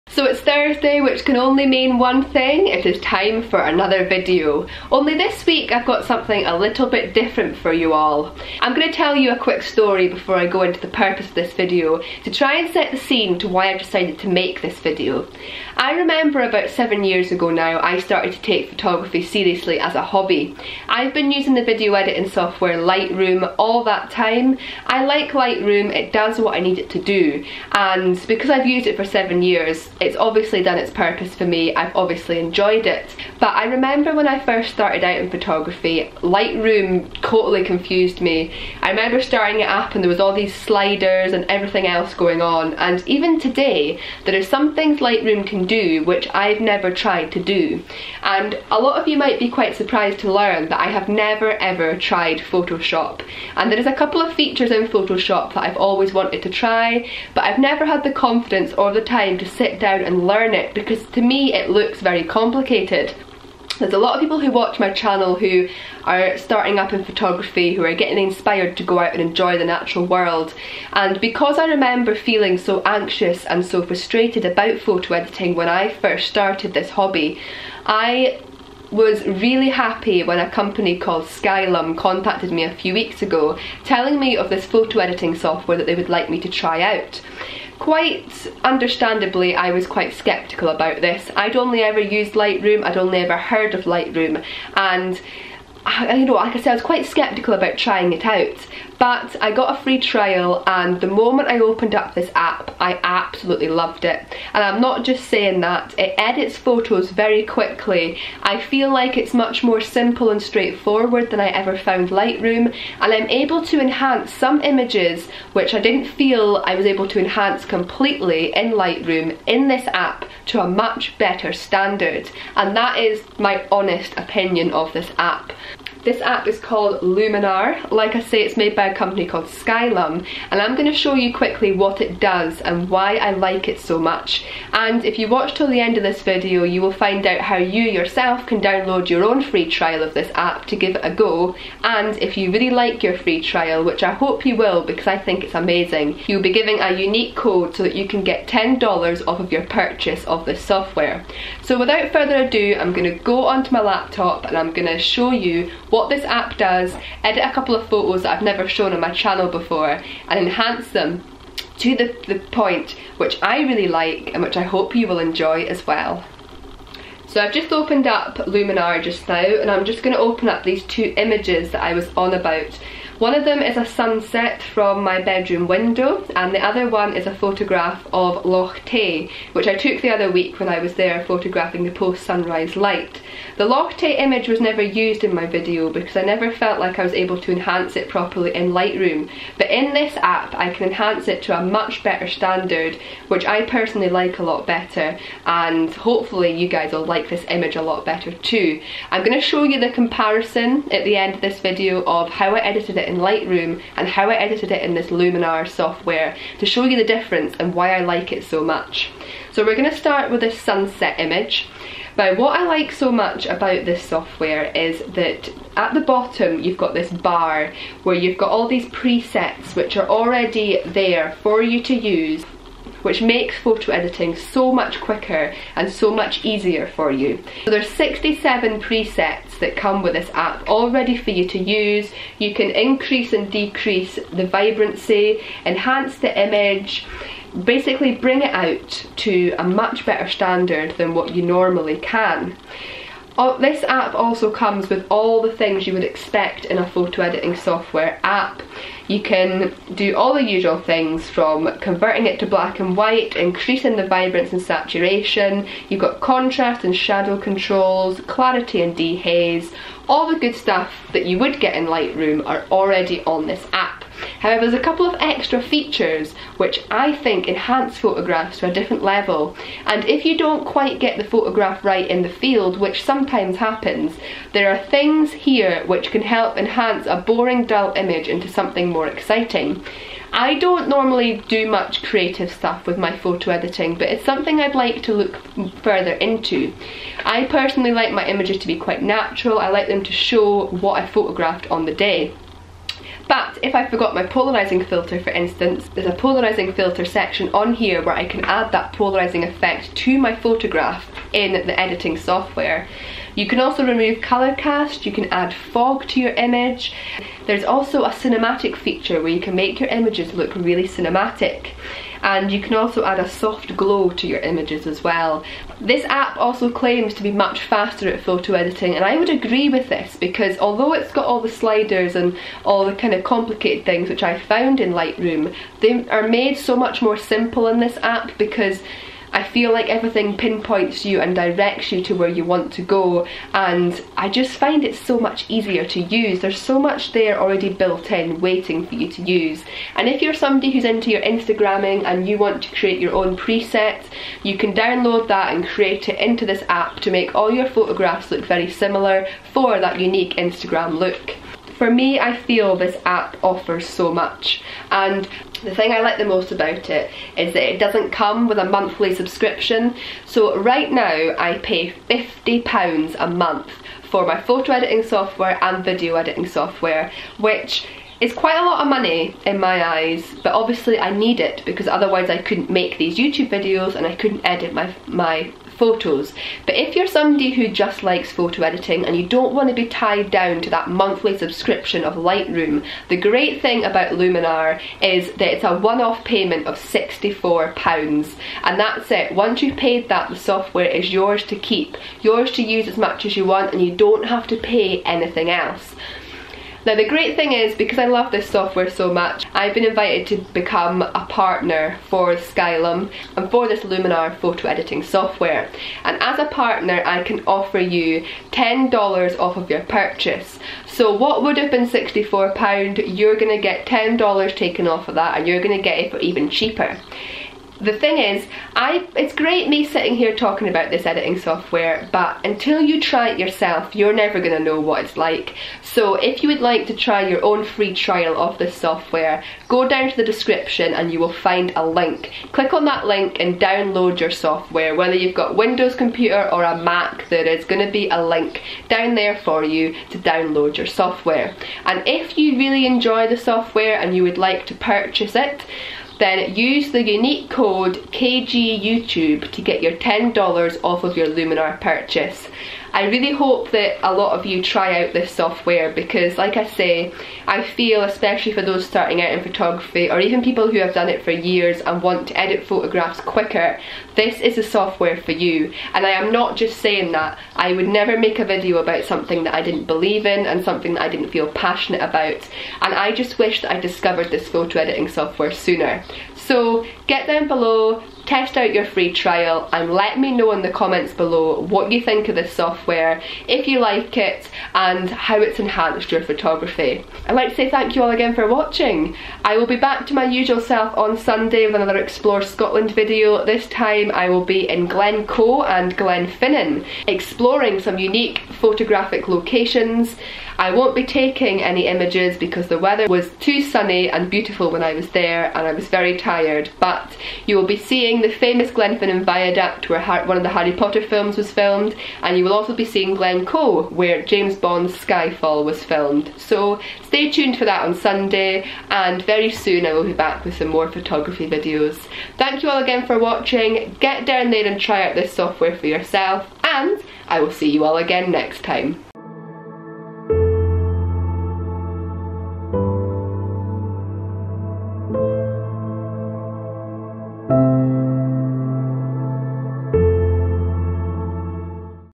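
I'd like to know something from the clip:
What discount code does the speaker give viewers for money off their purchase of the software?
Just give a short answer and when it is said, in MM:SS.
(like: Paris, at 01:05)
KGYouTube, at 07:28.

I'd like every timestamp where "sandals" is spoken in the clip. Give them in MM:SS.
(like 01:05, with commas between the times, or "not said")
not said.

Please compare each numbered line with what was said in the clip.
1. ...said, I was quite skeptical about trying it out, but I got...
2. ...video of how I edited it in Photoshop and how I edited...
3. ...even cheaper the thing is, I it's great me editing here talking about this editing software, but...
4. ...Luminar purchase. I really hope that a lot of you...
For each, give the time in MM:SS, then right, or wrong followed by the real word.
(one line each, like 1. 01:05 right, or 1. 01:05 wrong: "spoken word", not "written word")
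1. 01:36 right
2. 03:21 wrong: "Lightroom", not "Photoshop"
3. 06:56 wrong: "sitting", not "editing"
4. 07:31 right.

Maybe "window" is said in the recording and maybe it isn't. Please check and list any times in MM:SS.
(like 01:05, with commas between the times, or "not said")
02:55, 07:15.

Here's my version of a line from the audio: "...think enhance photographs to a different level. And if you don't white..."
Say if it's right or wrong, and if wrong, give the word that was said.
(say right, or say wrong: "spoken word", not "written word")
wrong: "quite", not "white".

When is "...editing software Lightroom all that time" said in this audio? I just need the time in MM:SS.
00:21.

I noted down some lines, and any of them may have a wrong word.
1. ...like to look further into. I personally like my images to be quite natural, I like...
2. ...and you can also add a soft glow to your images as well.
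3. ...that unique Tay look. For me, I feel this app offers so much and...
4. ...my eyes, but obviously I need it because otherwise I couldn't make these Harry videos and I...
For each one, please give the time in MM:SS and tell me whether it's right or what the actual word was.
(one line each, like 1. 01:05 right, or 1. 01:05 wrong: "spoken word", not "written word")
1. 04:44 right
2. 05:12 right
3. 05:49 wrong: "Instagram", not "Tay"
4. 06:09 wrong: "YouTube", not "Harry".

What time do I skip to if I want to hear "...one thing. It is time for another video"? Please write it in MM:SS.
00:01.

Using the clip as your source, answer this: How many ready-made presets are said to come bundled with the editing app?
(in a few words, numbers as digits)
67.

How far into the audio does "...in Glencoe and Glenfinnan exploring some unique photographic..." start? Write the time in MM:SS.
08:14.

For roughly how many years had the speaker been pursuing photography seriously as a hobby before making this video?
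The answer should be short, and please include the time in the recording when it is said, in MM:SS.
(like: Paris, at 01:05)
7, at 00:16.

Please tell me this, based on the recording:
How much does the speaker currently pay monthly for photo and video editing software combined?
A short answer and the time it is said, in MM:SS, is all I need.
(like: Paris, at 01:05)
£50, at 06:02.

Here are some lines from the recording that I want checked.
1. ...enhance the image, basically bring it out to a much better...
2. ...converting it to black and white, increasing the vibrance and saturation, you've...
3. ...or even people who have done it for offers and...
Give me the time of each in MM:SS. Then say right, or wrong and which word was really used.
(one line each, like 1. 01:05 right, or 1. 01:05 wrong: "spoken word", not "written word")
1. 03:55 right
2. 04:11 right
3. 07:40 wrong: "years", not "offers".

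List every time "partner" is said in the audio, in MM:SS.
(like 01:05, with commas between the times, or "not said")
06:41, 06:46.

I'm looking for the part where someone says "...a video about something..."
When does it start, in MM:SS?
07:48.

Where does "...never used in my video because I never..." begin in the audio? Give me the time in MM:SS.
03:04.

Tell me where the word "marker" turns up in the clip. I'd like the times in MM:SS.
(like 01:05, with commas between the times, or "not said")
not said.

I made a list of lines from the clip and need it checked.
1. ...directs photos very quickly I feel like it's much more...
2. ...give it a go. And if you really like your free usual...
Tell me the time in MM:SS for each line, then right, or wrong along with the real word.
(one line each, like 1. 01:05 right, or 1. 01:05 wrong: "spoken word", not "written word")
1. 01:46 wrong: "edits", not "directs"
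2. 02:20 wrong: "trial", not "usual".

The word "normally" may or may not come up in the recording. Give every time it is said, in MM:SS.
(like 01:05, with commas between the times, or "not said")
04:01, 04:40.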